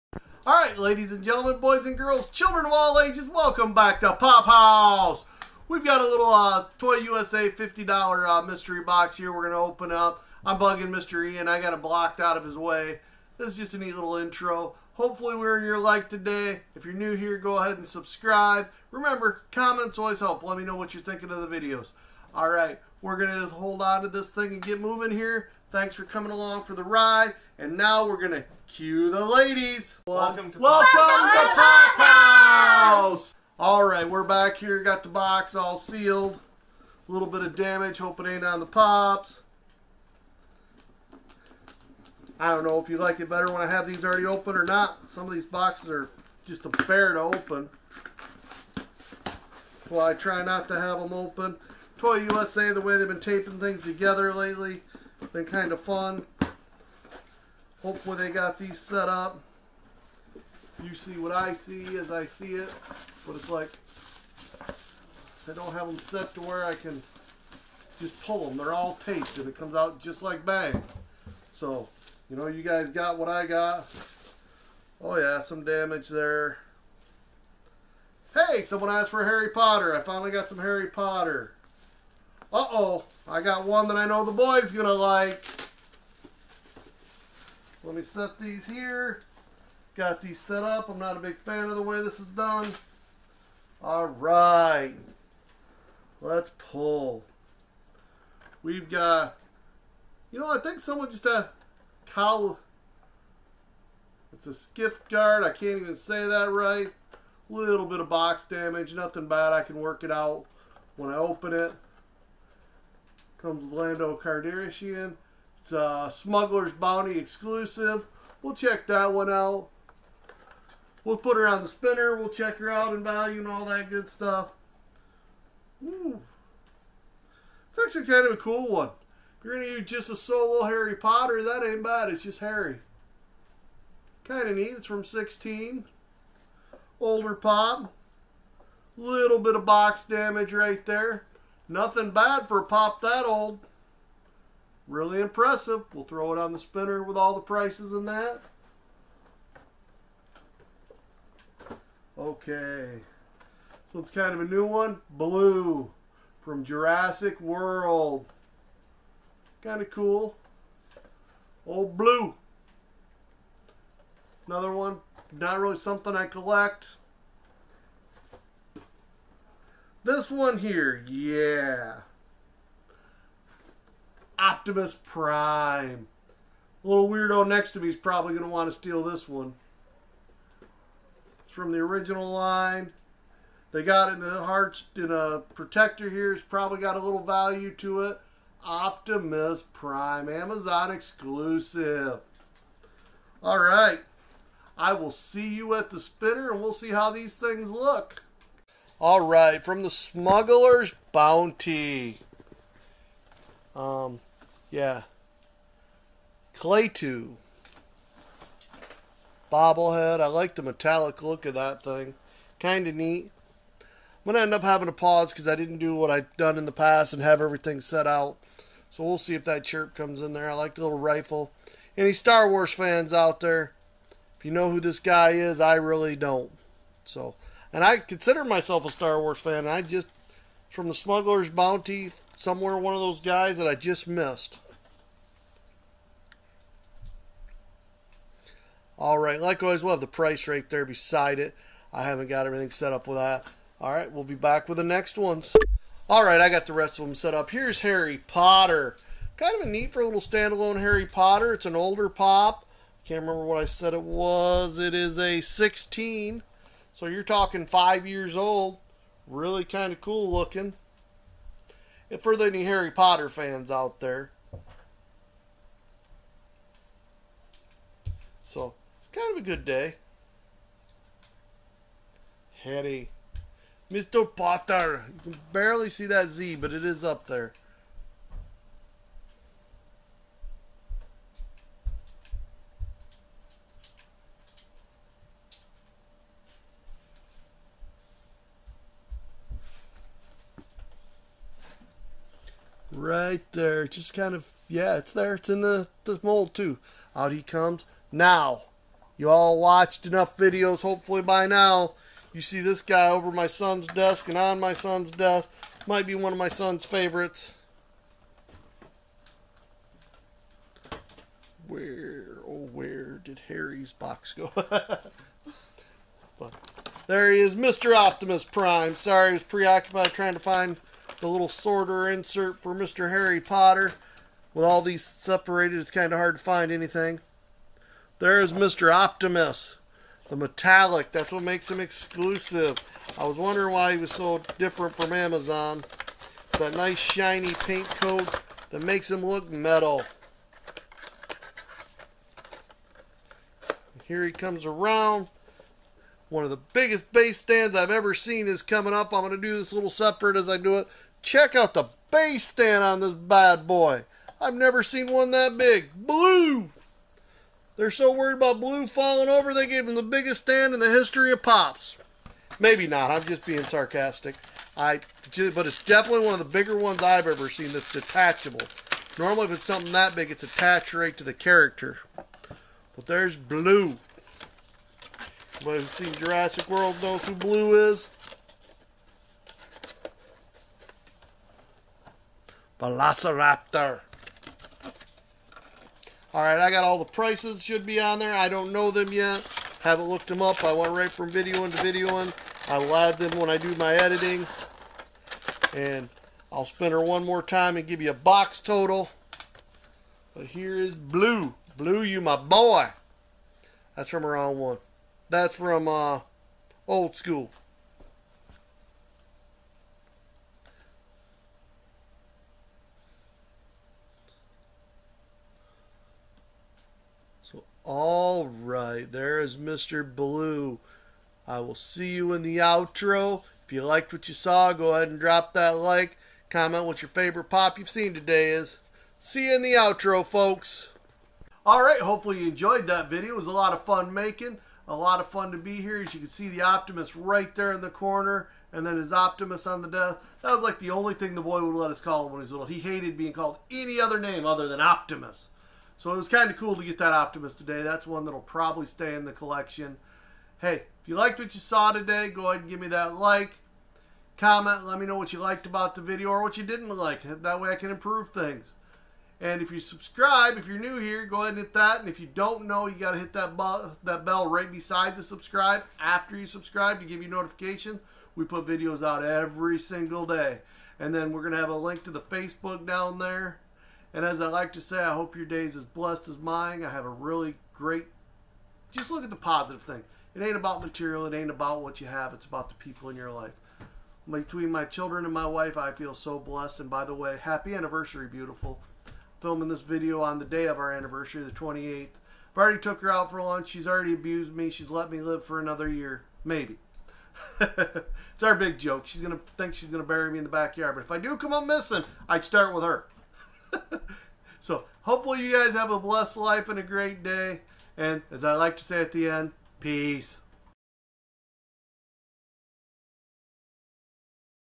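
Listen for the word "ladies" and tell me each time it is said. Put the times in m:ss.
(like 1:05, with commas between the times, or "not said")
0:00, 0:29.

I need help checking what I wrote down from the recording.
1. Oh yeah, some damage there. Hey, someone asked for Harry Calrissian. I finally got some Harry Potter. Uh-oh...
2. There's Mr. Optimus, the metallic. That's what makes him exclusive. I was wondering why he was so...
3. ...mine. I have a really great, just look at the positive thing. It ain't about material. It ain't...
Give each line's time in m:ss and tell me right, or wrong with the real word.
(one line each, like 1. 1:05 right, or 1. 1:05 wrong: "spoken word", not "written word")
1. 1:15 wrong: "Potter", not "Calrissian"
2. 5:28 right
3. 7:56 right.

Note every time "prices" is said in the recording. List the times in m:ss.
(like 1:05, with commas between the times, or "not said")
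2:27, 4:00, 6:27.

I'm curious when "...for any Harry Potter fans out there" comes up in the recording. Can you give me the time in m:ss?
4:22.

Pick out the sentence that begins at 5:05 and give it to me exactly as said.
Might be one of my son's favorites.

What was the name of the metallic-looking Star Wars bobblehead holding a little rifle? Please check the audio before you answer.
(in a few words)
Klaatu.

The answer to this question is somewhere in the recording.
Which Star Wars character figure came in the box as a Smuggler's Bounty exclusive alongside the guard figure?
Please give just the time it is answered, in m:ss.
1:53.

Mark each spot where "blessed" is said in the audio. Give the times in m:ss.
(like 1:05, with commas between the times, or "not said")
7:55, 8:06, 8:25.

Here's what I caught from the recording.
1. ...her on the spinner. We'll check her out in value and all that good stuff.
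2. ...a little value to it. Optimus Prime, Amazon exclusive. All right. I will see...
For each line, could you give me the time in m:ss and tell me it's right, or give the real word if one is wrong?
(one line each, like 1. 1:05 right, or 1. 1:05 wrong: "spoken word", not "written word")
1. 2:01 right
2. 3:06 right.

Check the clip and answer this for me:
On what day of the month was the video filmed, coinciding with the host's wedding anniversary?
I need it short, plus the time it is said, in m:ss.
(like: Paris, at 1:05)
28th, at 8:11.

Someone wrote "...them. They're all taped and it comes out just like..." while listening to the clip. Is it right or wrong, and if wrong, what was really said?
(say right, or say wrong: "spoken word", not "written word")
right.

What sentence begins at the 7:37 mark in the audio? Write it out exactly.
That way I can improve things.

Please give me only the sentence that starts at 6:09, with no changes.
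Normally, if it's something that big, it's attached right to the character.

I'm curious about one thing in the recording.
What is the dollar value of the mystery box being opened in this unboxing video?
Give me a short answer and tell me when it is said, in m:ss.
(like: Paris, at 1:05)
$50, at 0:07.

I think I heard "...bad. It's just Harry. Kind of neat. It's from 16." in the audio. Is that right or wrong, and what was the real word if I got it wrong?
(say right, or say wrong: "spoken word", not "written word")
right.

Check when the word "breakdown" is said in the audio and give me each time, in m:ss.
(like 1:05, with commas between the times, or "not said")
not said.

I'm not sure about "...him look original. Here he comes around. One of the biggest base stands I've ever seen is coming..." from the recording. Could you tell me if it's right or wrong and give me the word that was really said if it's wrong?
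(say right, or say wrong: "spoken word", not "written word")
wrong: "metal", not "original".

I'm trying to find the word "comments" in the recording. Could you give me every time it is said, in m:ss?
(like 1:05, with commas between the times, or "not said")
0:19, 7:06, 7:34.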